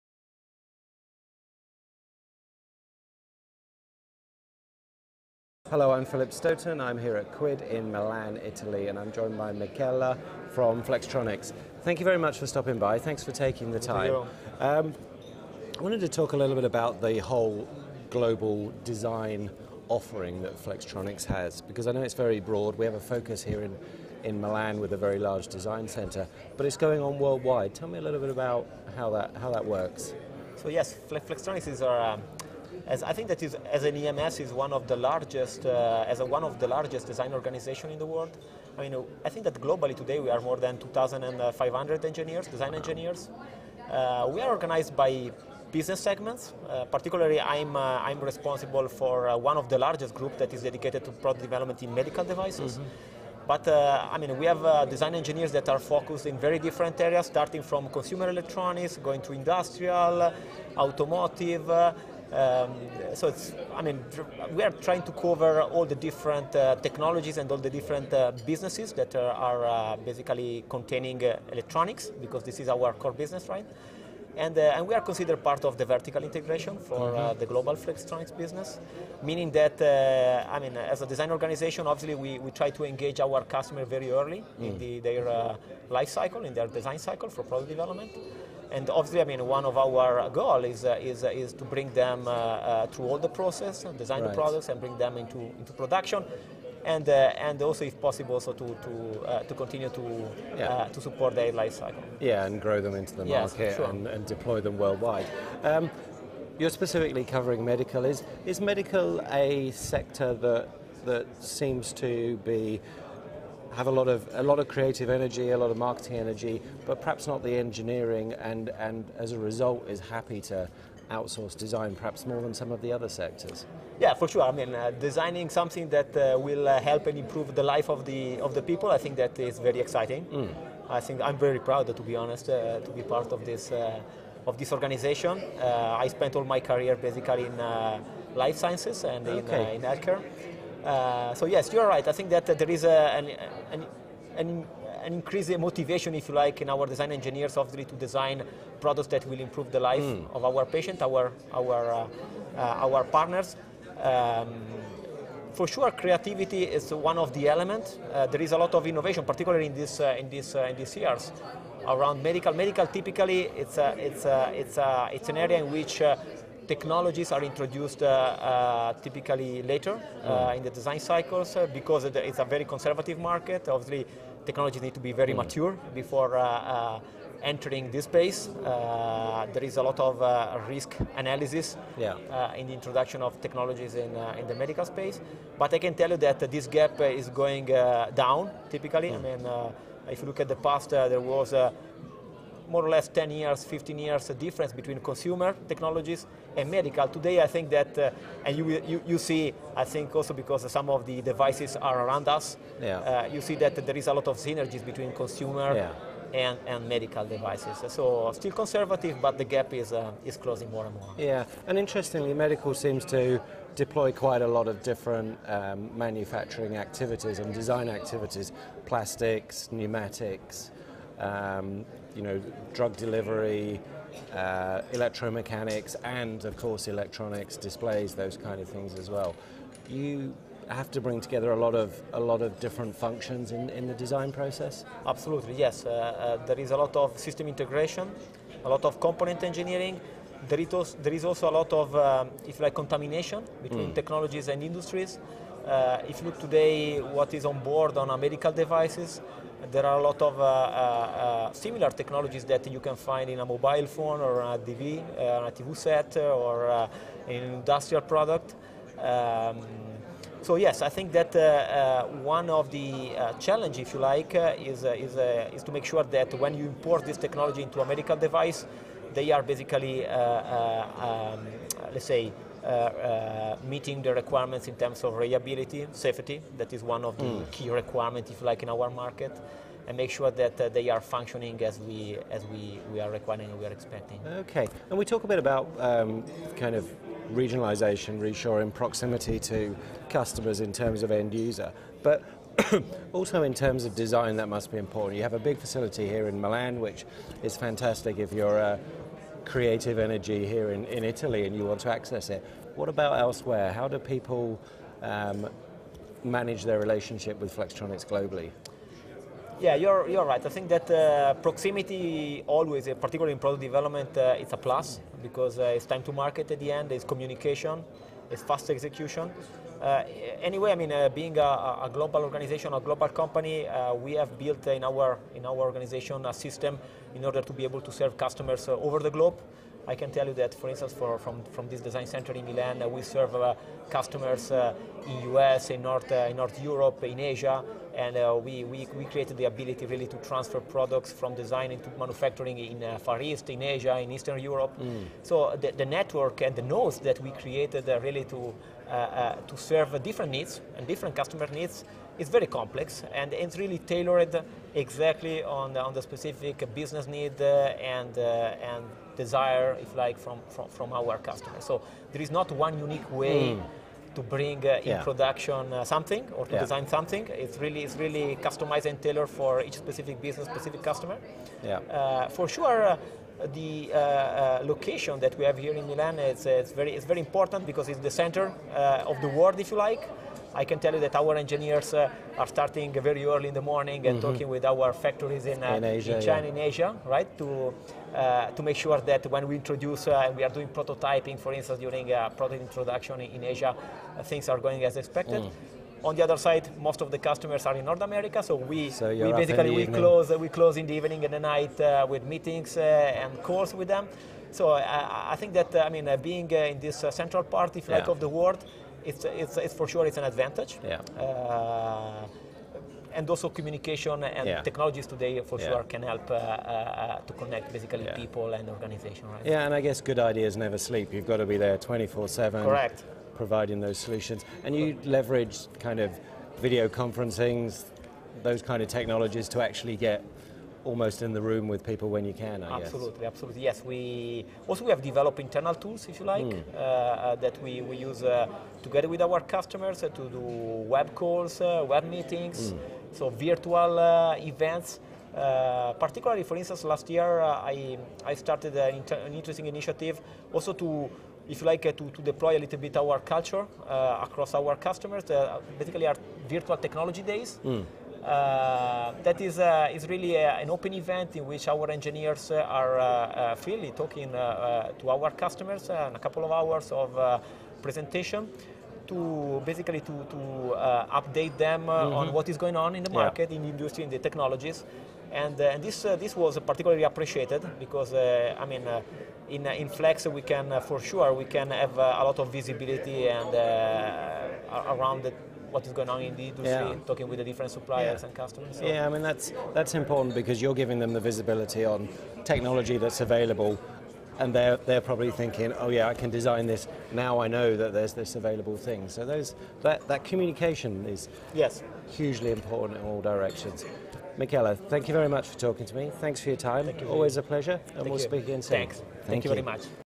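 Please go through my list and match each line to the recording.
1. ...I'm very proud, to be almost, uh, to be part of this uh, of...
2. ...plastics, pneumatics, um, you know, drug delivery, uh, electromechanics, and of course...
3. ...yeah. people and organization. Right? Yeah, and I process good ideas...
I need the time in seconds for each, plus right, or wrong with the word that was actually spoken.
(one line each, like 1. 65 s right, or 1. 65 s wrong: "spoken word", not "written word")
1. 131 s wrong: "honest", not "almost"
2. 218 s right
3. 418 s wrong: "guess", not "process".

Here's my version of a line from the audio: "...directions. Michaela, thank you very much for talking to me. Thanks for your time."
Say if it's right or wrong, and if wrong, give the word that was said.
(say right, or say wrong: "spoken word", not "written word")
right.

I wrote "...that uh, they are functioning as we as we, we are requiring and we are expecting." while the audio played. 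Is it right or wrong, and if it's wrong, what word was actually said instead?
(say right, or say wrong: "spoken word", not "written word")
right.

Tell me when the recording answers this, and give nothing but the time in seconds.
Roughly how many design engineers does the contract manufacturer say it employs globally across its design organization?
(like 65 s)
40 s.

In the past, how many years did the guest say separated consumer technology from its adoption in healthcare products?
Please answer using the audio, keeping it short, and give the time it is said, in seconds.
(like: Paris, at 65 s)
10 to 15 years, at 193 s.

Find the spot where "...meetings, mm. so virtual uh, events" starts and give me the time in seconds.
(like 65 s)
442 s.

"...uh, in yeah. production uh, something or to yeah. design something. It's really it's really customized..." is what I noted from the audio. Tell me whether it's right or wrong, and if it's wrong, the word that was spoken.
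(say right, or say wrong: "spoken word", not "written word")
right.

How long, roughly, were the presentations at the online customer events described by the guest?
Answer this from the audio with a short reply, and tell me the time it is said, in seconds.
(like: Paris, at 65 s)
a couple of hours, at 466 s.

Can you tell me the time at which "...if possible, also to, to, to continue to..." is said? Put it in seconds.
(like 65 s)
97 s.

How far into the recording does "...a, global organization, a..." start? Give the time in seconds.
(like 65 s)
321 s.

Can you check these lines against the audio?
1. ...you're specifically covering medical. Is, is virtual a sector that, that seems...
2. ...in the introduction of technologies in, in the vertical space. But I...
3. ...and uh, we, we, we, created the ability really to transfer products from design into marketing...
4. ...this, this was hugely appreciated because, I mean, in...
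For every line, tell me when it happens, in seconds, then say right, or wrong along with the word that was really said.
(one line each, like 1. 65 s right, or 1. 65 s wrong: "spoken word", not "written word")
1. 106 s wrong: "medical", not "virtual"
2. 182 s wrong: "medical", not "vertical"
3. 338 s wrong: "manufacturing", not "marketing"
4. 475 s wrong: "particularly", not "hugely".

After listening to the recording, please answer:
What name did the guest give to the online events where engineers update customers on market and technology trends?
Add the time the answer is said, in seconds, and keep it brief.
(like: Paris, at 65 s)
virtual technology days, at 456 s.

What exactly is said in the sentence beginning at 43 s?
Uh, we are organized by business segments.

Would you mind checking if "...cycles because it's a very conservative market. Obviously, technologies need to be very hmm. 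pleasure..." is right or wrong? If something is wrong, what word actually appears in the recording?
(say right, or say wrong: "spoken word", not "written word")
wrong: "mature", not "pleasure".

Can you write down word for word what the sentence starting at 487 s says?
talking with the different suppliers yeah.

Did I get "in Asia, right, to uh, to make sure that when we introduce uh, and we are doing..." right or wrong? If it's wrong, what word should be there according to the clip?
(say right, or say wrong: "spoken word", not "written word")
right.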